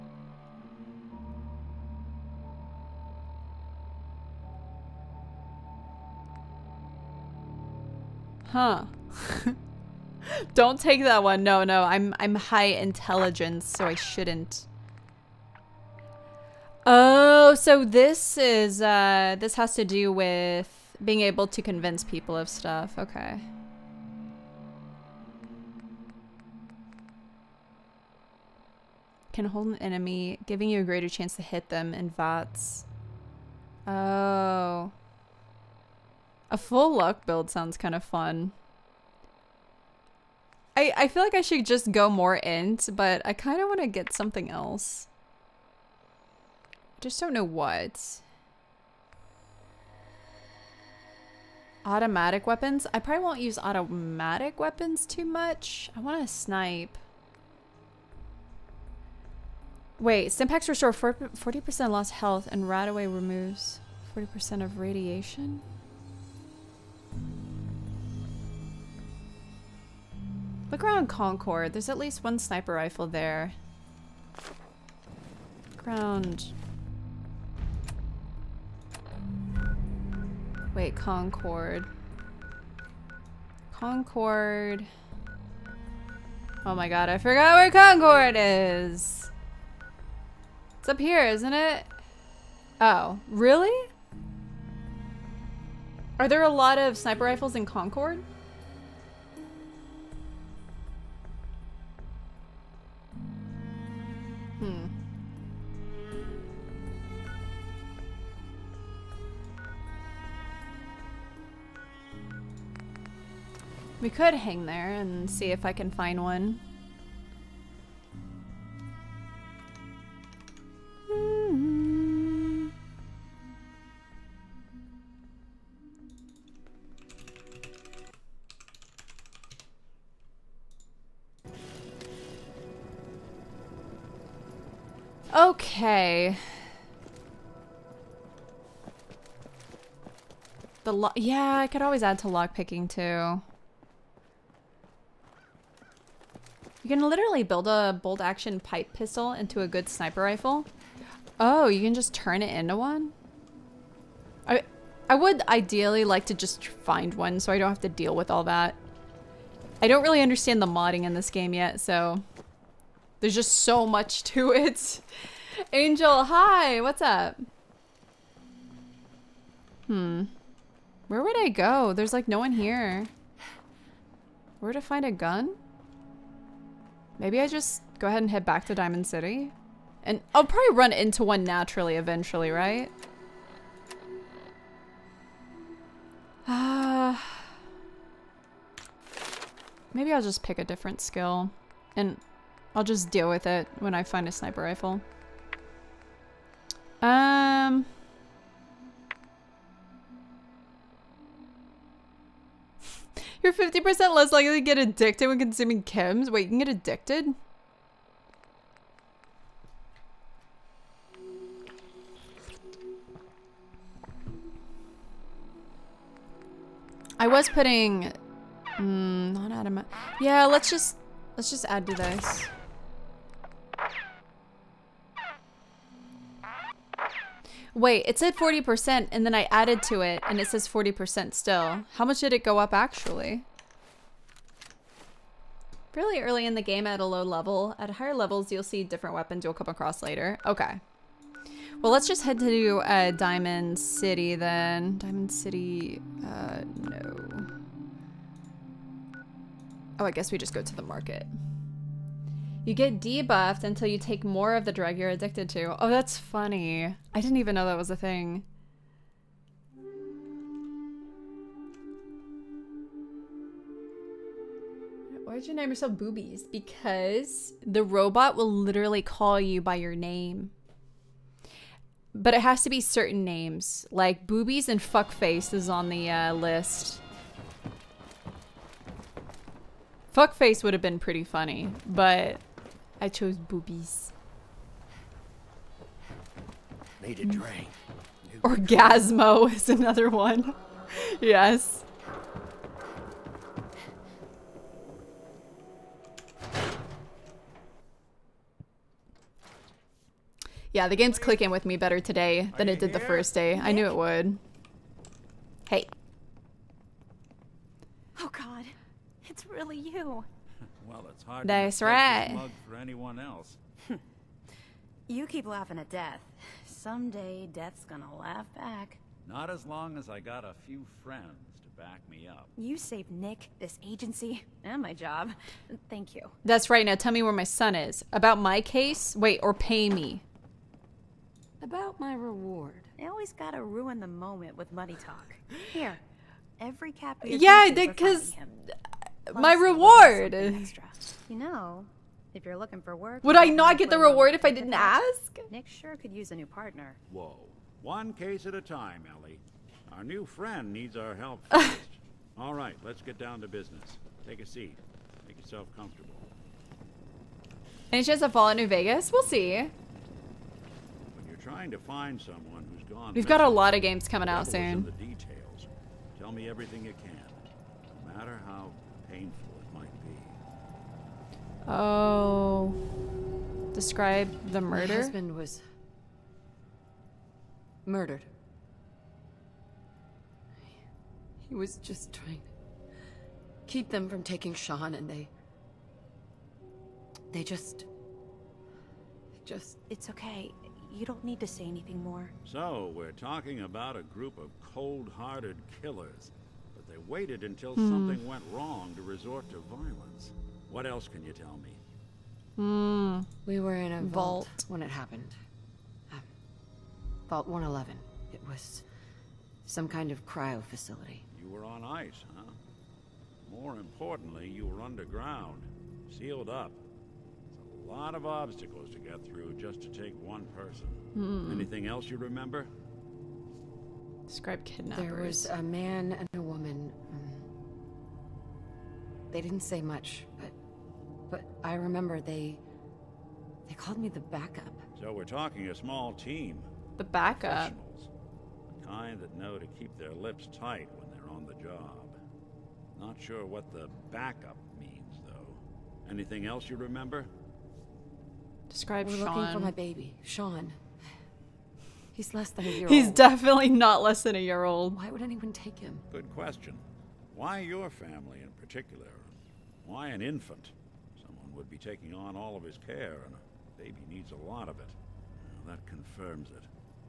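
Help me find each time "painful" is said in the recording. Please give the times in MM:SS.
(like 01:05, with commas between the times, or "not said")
06:09.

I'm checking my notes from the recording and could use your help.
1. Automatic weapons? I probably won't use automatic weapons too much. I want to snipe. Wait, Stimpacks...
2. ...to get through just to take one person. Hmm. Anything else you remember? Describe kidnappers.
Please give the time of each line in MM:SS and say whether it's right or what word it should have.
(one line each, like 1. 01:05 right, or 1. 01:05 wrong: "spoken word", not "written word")
1. 00:51 right
2. 06:58 right.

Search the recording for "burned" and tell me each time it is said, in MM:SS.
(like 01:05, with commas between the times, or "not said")
not said.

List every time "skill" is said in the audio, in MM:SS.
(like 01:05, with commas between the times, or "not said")
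03:10.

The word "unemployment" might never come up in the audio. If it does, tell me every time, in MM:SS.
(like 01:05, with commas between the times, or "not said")
not said.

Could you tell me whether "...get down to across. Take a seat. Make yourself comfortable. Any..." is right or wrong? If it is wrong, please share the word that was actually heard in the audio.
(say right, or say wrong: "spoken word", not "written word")
wrong: "business", not "across".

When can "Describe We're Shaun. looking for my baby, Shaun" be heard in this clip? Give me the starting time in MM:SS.
07:28.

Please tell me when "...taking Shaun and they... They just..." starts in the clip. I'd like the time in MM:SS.
06:24.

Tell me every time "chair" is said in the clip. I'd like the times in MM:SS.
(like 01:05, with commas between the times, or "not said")
not said.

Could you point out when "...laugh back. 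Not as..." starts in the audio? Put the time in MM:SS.
05:18.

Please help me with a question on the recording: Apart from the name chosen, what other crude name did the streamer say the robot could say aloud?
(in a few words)
Orgasmo.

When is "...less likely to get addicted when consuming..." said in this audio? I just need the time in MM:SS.
03:24.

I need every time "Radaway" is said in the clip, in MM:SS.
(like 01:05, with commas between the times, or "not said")
01:02.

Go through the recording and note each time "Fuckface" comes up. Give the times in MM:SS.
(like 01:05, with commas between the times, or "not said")
04:34, 04:40.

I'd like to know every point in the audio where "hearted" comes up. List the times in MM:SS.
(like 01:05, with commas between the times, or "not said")
06:34.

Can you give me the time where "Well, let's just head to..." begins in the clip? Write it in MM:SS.
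04:01.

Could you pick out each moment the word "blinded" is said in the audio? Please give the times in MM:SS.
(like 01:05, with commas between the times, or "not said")
not said.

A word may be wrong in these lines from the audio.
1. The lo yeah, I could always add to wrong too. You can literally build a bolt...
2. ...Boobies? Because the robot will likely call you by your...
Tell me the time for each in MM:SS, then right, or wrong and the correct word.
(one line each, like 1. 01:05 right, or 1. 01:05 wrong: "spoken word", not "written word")
1. 02:20 wrong: "lockpicking", not "wrong"
2. 04:25 wrong: "literally", not "likely".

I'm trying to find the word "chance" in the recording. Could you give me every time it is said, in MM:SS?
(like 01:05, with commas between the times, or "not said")
00:31, 05:58.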